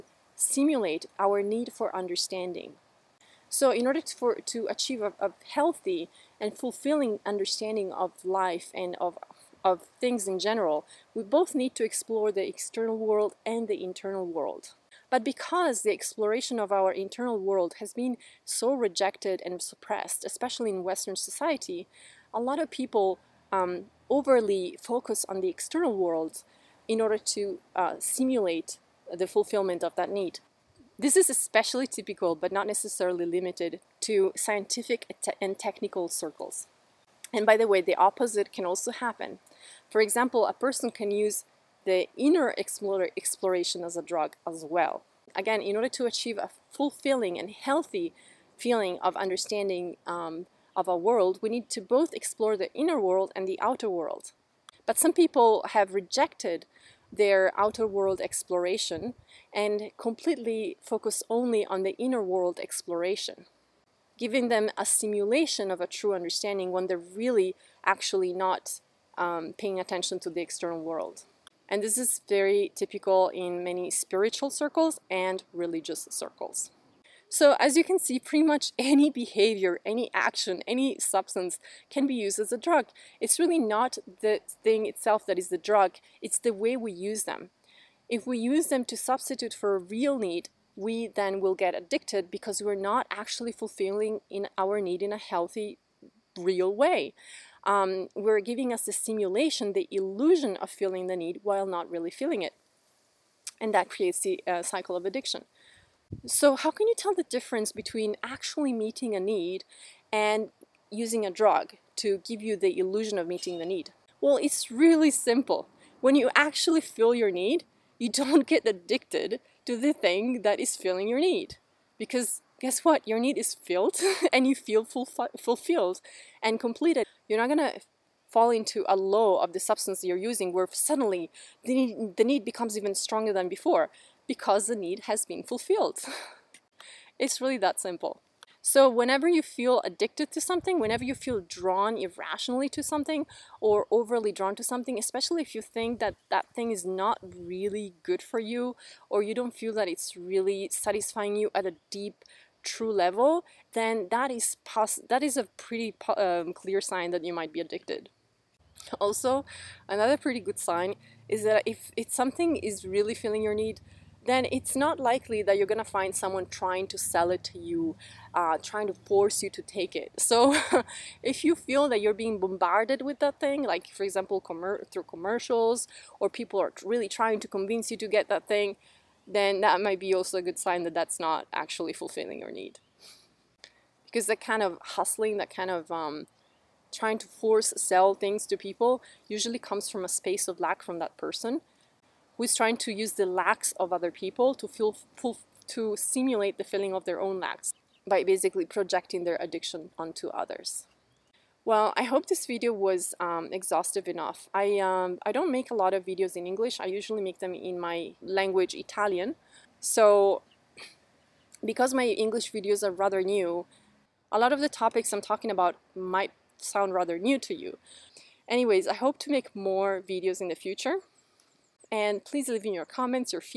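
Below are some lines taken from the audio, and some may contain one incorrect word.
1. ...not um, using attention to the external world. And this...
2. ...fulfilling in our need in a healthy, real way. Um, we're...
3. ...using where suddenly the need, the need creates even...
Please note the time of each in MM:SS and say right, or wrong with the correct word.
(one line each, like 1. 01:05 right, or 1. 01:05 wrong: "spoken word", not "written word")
1. 01:08 wrong: "paying", not "using"
2. 01:33 right
3. 02:10 wrong: "becomes", not "creates".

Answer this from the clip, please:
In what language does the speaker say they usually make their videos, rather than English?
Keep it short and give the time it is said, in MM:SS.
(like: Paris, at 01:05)
Italian, at 03:28.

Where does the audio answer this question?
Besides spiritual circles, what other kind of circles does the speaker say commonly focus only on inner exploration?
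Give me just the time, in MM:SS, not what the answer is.
01:15.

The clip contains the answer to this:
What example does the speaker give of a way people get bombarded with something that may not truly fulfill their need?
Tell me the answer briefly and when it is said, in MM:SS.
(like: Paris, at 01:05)
commercials, at 02:55.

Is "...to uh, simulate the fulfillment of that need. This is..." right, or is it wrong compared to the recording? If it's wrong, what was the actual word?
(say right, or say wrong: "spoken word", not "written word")
right.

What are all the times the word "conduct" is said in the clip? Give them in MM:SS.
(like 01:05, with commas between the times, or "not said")
not said.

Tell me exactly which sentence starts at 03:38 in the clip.
Anyways, I hope to make more videos in the future.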